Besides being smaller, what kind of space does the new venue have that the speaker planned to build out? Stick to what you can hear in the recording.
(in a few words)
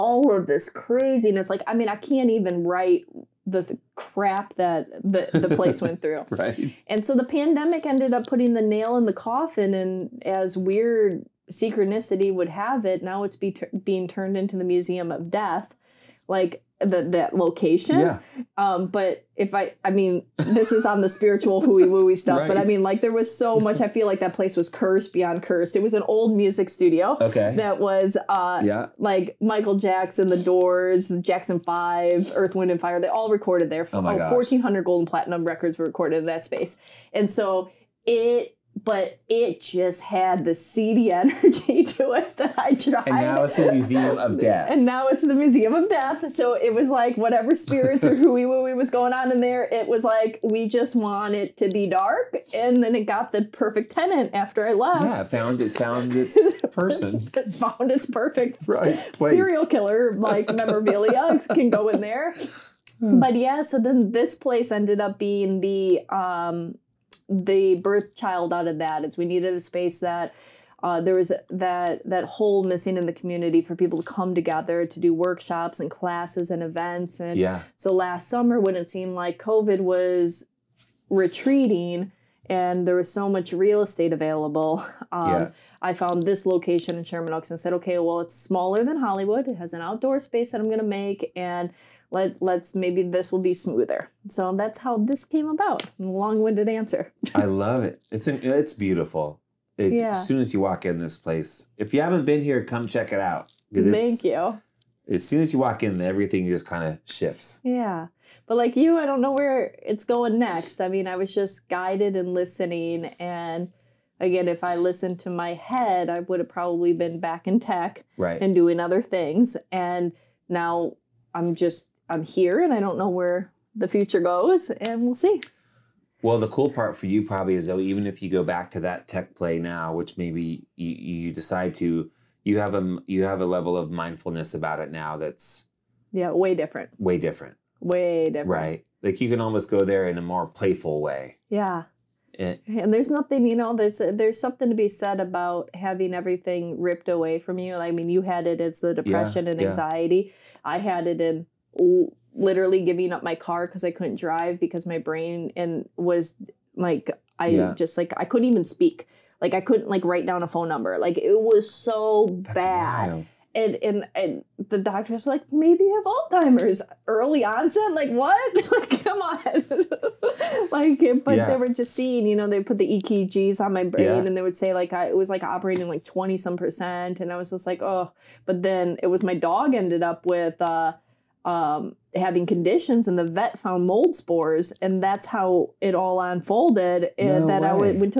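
Outdoor space.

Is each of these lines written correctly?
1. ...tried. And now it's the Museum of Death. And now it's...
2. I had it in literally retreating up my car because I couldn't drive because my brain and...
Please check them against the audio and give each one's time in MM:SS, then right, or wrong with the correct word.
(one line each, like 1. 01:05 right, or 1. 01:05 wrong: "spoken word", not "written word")
1. 00:42 right
2. 02:30 wrong: "giving", not "retreating".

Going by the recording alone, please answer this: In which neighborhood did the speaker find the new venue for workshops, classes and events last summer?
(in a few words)
Sherman Oaks.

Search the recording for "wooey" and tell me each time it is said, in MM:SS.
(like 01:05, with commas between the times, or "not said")
00:21, 00:48.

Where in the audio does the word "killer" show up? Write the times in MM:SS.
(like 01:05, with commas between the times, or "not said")
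00:59.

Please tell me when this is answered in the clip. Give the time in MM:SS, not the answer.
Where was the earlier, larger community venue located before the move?
01:28.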